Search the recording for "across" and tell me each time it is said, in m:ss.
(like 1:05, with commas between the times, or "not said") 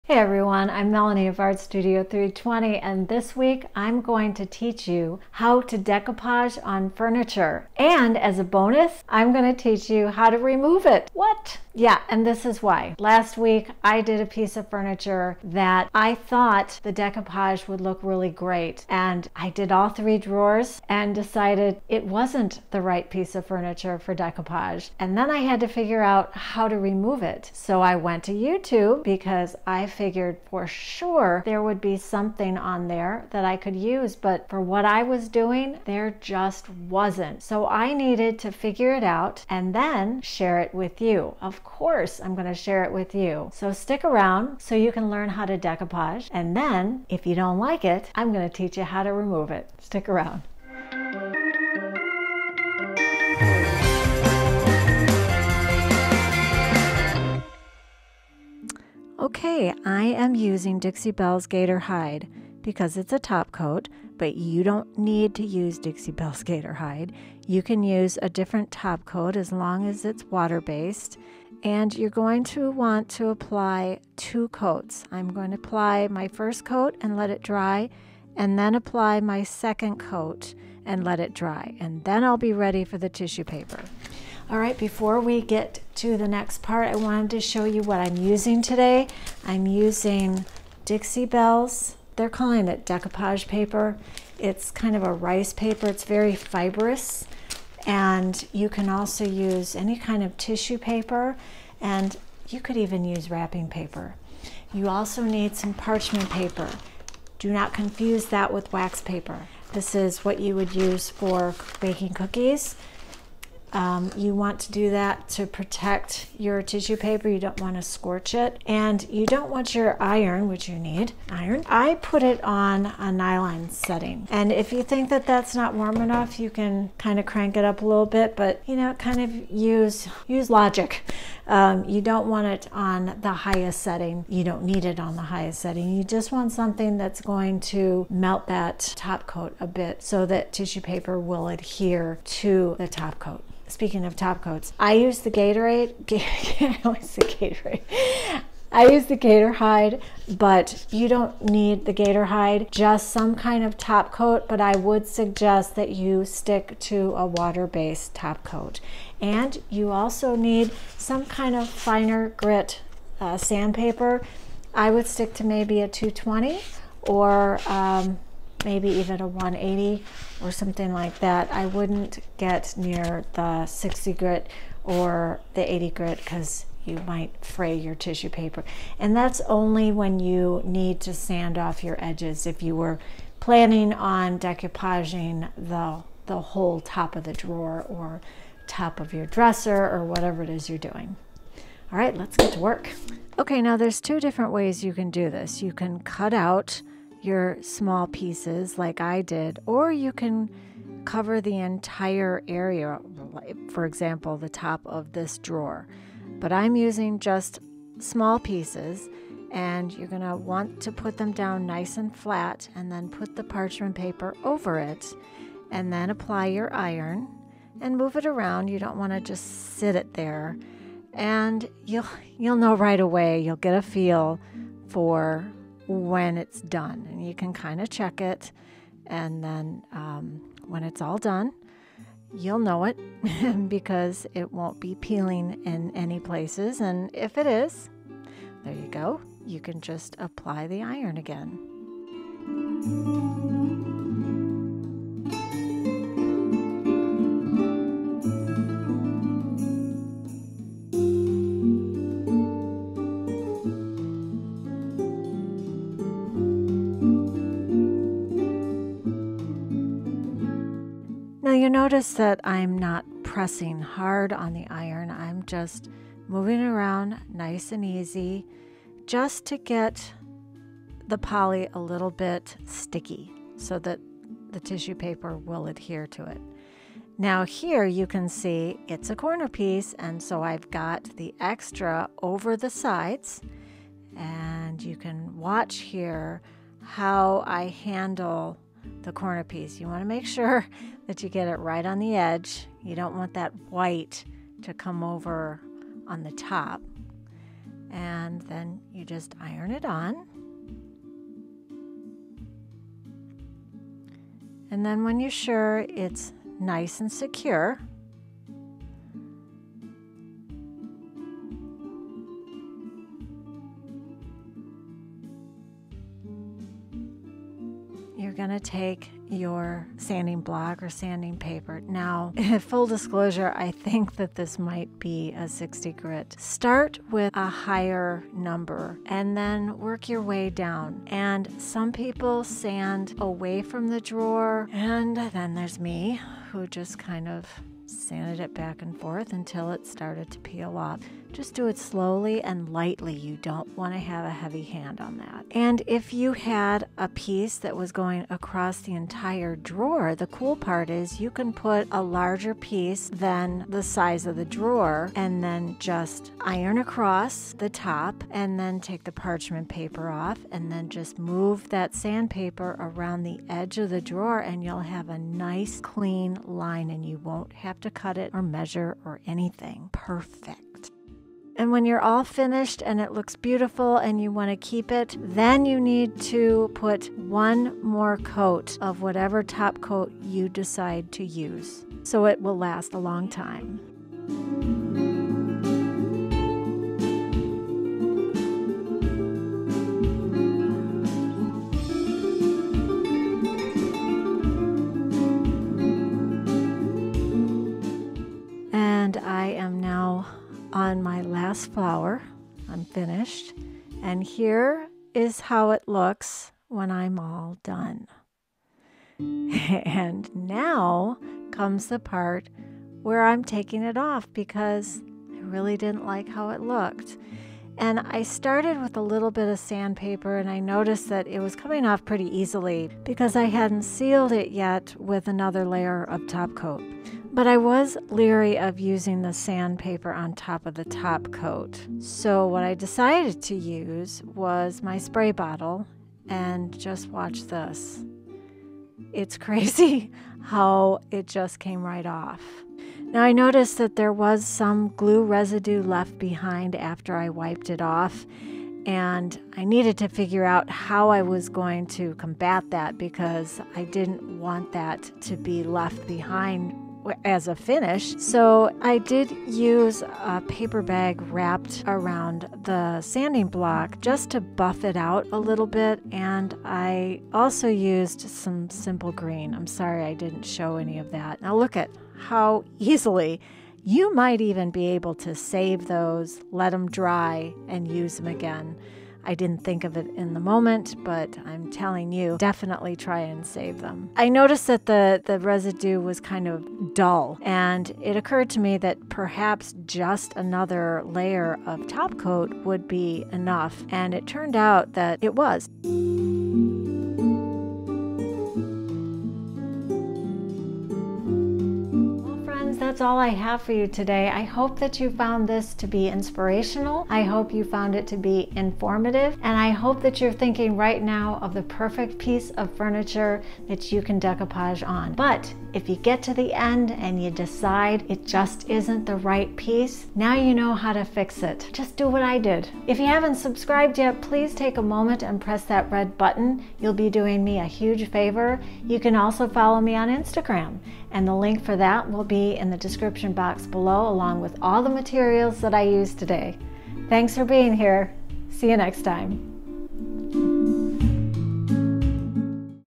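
5:48, 5:56.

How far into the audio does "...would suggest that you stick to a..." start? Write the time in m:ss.
2:34.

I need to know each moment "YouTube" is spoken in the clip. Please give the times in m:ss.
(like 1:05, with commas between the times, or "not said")
0:28.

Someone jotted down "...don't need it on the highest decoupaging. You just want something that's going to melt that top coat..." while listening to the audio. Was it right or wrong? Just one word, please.
wrong.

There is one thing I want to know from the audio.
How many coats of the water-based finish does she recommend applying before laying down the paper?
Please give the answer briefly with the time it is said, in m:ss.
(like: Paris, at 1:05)
2, at 1:14.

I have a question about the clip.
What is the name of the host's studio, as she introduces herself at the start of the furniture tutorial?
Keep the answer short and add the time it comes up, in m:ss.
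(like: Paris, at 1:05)
Art Studio 320, at 0:01.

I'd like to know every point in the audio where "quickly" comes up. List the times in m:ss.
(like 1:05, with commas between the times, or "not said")
not said.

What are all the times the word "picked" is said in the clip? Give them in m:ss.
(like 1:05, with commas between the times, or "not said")
not said.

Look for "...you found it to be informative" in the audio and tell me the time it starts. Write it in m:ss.
8:27.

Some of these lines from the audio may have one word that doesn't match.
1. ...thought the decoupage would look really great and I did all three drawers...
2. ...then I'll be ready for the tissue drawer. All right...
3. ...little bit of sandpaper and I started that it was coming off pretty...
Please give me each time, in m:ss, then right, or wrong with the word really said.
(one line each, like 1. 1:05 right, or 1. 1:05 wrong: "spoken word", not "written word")
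1. 0:16 right
2. 1:22 wrong: "paper", not "drawer"
3. 6:59 wrong: "noticed", not "started".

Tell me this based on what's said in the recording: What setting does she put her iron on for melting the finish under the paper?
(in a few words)
nylon.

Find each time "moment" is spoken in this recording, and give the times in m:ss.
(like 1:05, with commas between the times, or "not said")
8:00, 8:44.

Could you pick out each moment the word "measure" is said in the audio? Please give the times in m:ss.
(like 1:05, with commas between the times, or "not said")
6:08.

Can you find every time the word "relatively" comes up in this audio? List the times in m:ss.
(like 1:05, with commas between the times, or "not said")
not said.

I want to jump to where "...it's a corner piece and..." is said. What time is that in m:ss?
4:38.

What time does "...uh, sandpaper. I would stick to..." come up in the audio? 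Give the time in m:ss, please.
2:43.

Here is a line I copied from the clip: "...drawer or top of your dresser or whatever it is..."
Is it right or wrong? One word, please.
right.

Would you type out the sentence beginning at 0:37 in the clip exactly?
So I needed to figure it out and then share it with you.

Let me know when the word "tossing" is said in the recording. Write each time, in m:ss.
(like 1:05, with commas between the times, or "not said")
not said.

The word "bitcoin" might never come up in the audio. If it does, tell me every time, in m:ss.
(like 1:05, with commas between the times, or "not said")
not said.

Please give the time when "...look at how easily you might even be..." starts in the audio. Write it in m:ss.
7:51.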